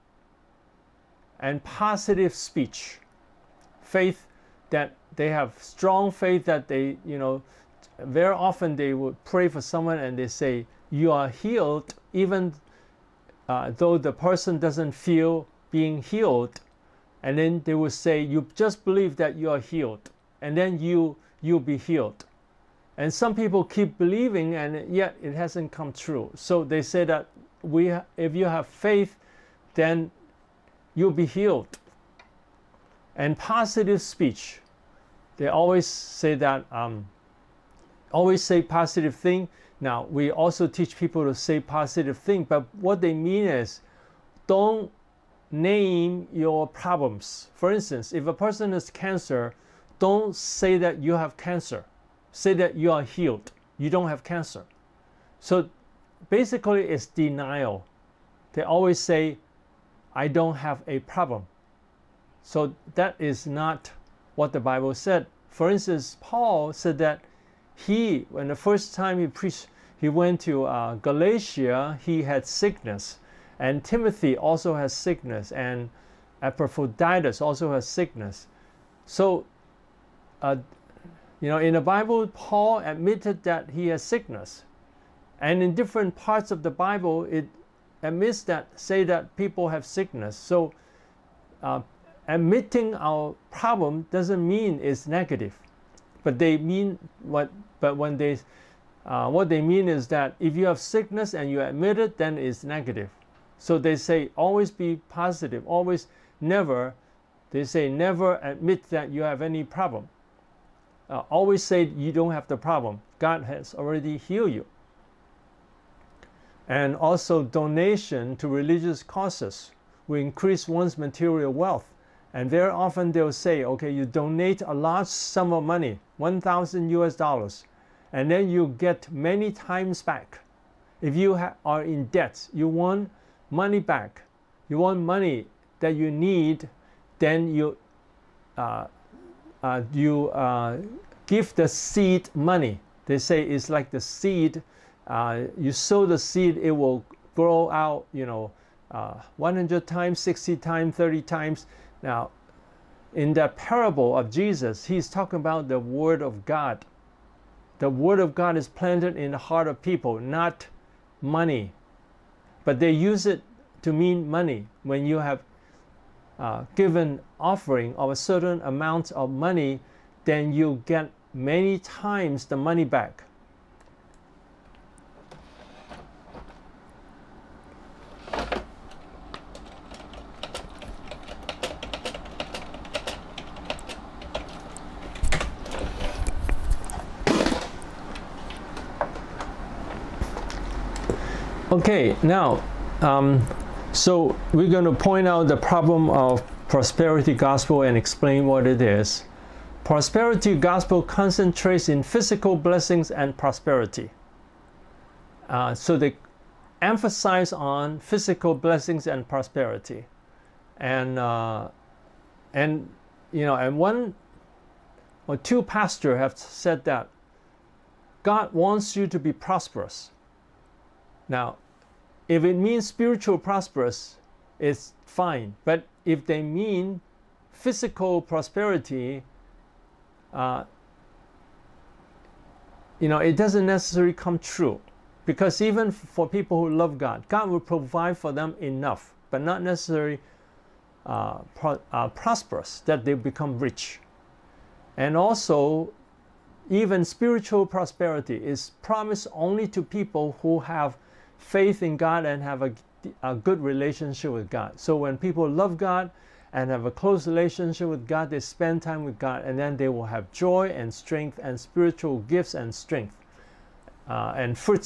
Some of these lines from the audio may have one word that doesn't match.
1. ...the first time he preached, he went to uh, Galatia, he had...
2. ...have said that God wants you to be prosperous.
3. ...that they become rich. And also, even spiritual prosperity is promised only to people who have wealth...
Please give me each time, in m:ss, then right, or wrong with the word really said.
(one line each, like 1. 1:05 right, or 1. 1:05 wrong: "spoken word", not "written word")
1. 1:08 right
2. 3:36 right
3. 4:02 wrong: "faith", not "wealth".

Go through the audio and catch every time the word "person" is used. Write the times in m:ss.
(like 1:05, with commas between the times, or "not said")
0:14, 0:48.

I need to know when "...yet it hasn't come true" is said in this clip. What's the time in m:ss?
0:24.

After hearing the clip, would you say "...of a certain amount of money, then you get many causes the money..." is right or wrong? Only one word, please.
wrong.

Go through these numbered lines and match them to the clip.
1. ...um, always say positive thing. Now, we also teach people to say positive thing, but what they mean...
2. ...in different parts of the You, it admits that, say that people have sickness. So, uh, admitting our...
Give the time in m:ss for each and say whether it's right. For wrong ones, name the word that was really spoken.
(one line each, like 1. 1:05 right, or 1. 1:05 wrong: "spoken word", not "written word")
1. 0:36 right
2. 1:25 wrong: "Bible", not "You".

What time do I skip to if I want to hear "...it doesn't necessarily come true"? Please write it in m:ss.
3:53.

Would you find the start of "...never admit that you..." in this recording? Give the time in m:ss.
1:47.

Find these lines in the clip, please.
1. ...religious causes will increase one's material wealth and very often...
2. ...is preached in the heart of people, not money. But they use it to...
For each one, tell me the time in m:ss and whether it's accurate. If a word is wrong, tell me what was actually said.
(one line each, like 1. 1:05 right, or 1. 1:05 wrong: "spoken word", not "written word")
1. 1:58 right
2. 2:38 wrong: "planted", not "preached".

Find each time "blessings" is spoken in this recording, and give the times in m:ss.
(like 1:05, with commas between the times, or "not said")
3:22, 3:28.